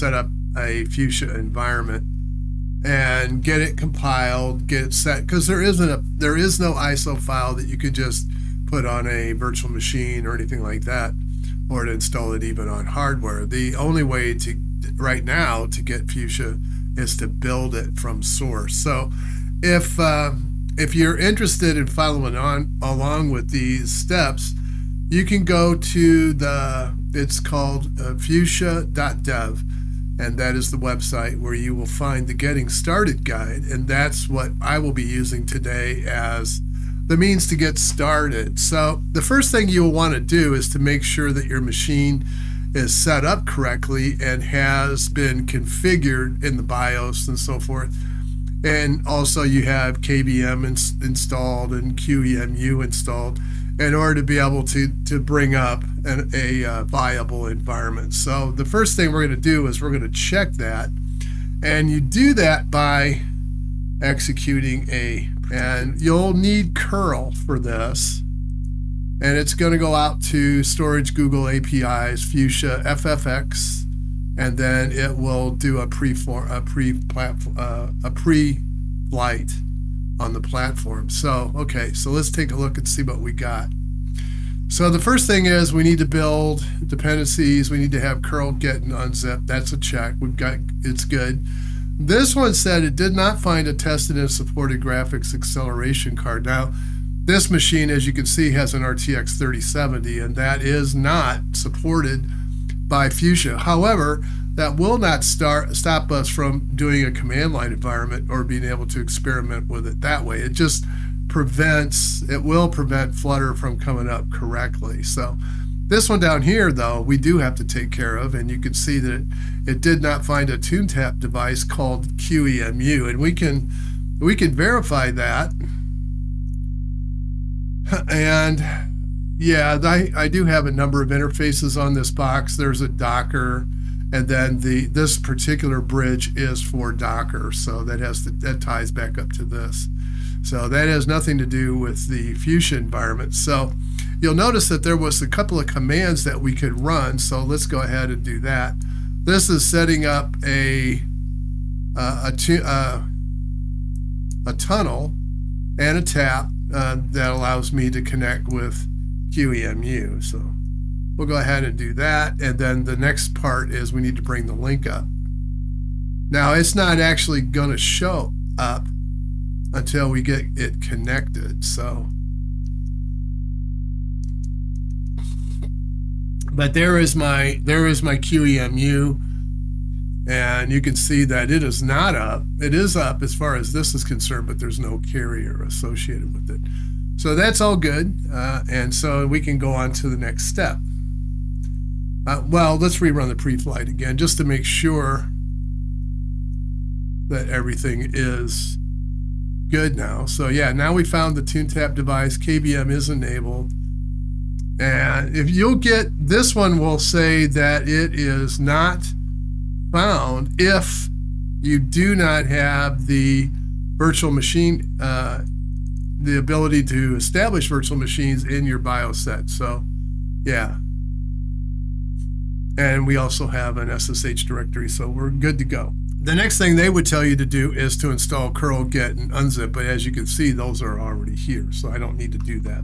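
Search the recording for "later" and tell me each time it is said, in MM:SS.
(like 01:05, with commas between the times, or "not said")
not said.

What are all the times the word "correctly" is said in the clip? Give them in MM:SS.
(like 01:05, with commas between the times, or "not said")
00:43, 01:54.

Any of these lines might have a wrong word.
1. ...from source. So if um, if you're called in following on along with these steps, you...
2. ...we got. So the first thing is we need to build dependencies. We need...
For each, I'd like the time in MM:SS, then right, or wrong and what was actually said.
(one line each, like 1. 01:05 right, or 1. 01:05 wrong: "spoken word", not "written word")
1. 00:17 wrong: "interested", not "called"
2. 01:23 right.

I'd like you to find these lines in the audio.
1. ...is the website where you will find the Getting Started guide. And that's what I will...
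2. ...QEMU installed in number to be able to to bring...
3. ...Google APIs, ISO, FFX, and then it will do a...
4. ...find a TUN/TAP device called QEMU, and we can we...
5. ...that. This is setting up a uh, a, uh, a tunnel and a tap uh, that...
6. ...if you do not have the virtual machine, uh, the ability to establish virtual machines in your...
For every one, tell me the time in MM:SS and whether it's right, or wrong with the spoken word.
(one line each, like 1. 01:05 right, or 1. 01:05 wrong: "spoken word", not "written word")
1. 00:30 right
2. 00:51 wrong: "order", not "number"
3. 01:11 wrong: "Fuchsia", not "ISO"
4. 02:00 right
5. 02:28 right
6. 03:30 right.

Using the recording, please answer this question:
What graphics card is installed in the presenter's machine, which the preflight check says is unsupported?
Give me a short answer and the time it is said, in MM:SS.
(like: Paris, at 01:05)
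RTX 3070, at 01:38.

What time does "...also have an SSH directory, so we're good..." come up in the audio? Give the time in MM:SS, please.
03:43.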